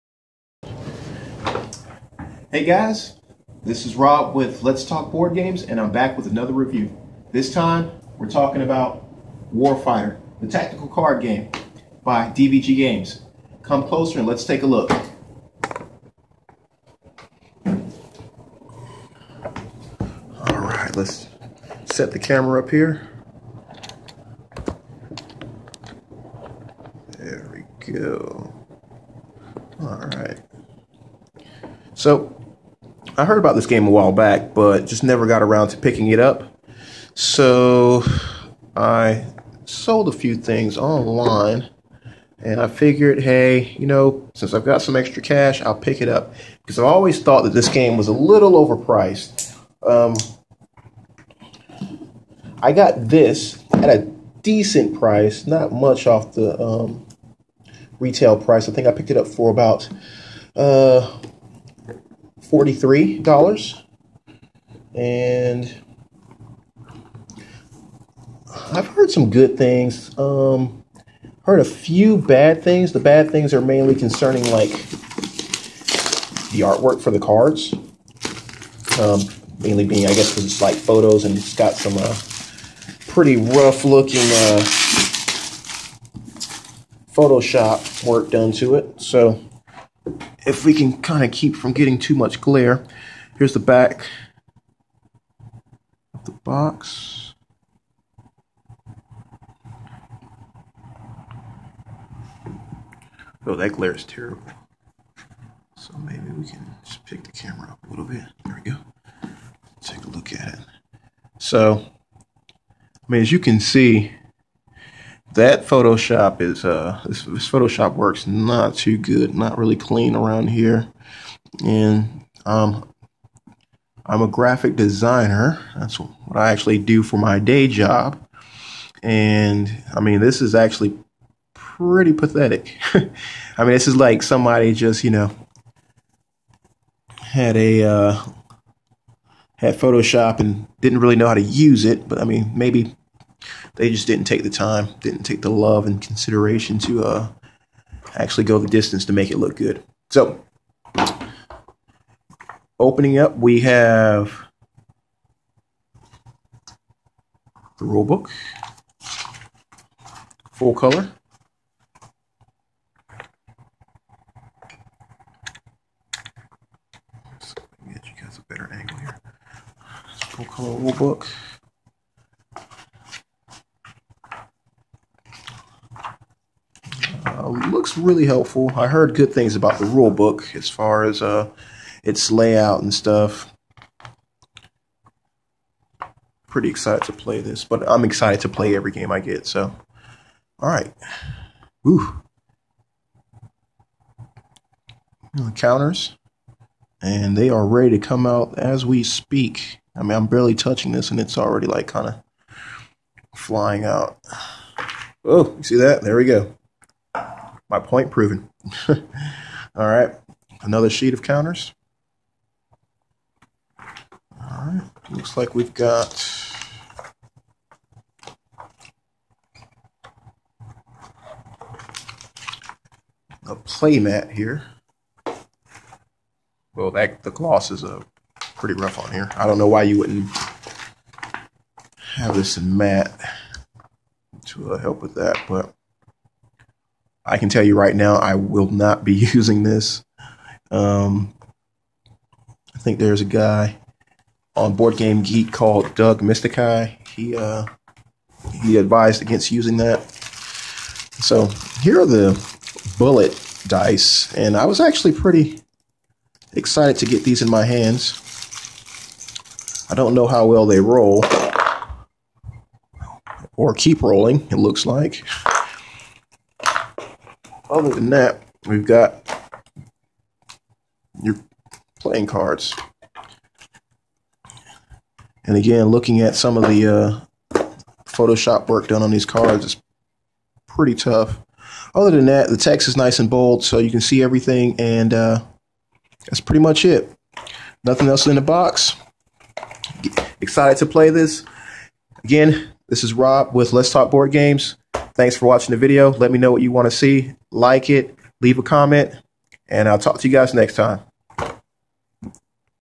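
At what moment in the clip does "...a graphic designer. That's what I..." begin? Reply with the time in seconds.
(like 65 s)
124 s.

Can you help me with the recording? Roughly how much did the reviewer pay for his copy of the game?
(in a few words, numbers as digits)
$43.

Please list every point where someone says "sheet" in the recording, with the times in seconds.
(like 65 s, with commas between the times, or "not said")
210 s.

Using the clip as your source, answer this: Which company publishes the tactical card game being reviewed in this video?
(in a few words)
DVG Games.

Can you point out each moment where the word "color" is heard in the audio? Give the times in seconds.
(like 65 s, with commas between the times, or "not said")
160 s, 170 s.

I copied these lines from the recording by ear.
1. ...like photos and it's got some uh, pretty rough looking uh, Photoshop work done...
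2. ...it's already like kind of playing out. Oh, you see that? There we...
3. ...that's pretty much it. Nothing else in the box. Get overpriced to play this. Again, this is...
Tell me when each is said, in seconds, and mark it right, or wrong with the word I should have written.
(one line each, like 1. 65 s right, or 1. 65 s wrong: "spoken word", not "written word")
1. 80 s right
2. 201 s wrong: "flying", not "playing"
3. 286 s wrong: "excited", not "overpriced".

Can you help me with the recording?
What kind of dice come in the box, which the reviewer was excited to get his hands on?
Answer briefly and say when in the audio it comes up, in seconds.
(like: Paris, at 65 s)
Bullet dice, at 252 s.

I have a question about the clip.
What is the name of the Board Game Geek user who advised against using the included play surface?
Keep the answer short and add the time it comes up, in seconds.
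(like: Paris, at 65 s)
Doug Mystikai, at 245 s.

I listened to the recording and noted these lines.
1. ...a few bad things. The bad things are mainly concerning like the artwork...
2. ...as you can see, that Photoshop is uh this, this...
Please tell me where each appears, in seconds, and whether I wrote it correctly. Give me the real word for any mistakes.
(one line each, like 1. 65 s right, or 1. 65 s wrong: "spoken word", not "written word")
1. 71 s right
2. 113 s right.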